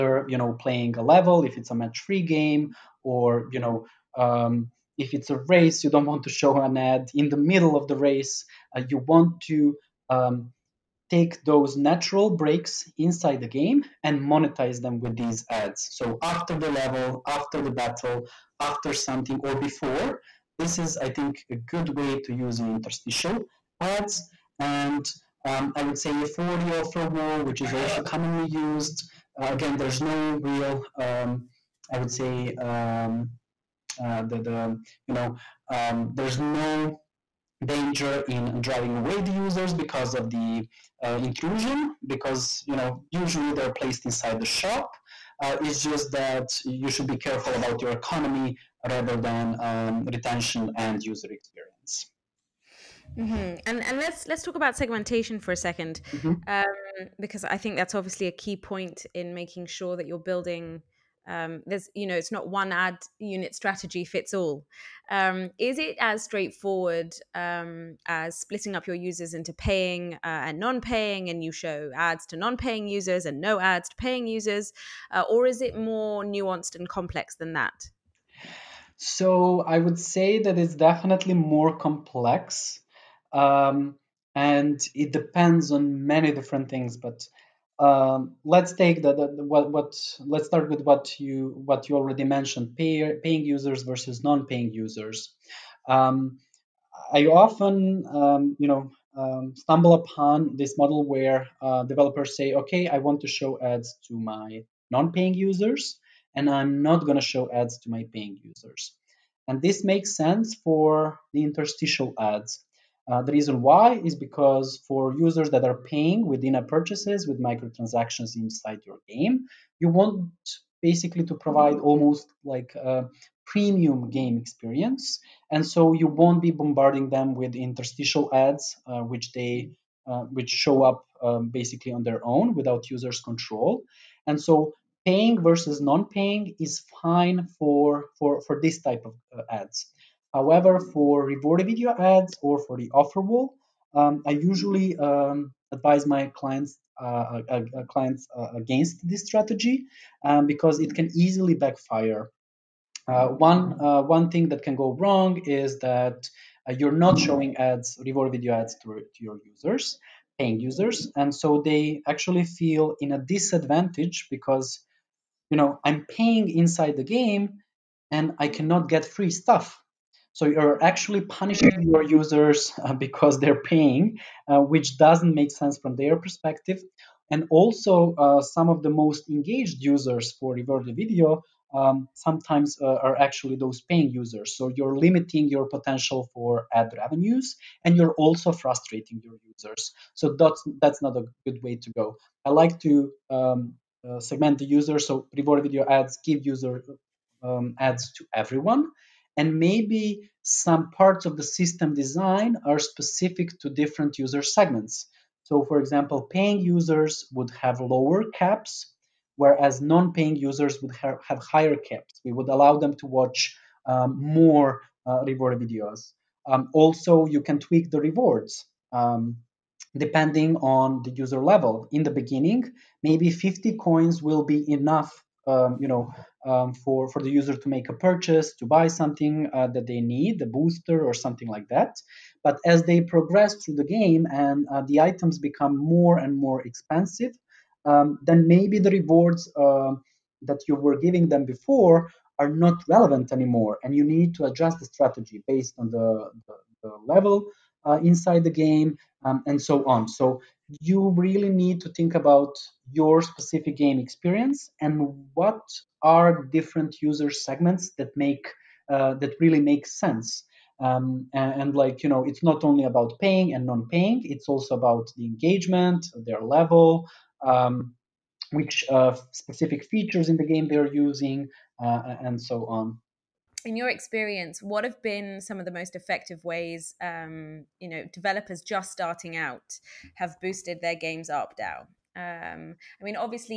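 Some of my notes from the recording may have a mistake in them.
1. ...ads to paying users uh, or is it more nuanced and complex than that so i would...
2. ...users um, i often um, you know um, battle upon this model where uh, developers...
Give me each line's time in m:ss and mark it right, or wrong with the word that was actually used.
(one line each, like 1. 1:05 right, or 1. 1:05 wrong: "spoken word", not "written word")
1. 1:13 right
2. 1:34 wrong: "stumble", not "battle".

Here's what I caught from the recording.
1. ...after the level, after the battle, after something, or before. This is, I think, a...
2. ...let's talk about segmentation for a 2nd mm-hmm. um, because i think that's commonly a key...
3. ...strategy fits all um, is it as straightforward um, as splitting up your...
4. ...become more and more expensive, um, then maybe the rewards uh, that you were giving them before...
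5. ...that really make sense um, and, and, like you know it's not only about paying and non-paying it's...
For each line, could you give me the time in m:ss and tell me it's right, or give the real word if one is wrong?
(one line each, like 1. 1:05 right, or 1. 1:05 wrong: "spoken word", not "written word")
1. 0:16 right
2. 0:54 wrong: "obviously", not "commonly"
3. 1:03 right
4. 3:55 right
5. 4:19 right.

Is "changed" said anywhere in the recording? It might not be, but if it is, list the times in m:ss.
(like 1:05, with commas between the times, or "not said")
not said.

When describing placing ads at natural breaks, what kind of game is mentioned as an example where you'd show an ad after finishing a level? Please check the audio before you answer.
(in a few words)
match-three game.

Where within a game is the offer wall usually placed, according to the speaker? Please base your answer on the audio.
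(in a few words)
inside the shop.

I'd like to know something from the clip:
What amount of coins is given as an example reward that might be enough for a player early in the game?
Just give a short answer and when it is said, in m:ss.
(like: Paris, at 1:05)
50 coins, at 3:43.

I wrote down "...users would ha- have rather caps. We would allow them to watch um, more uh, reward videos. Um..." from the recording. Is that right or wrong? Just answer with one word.
wrong.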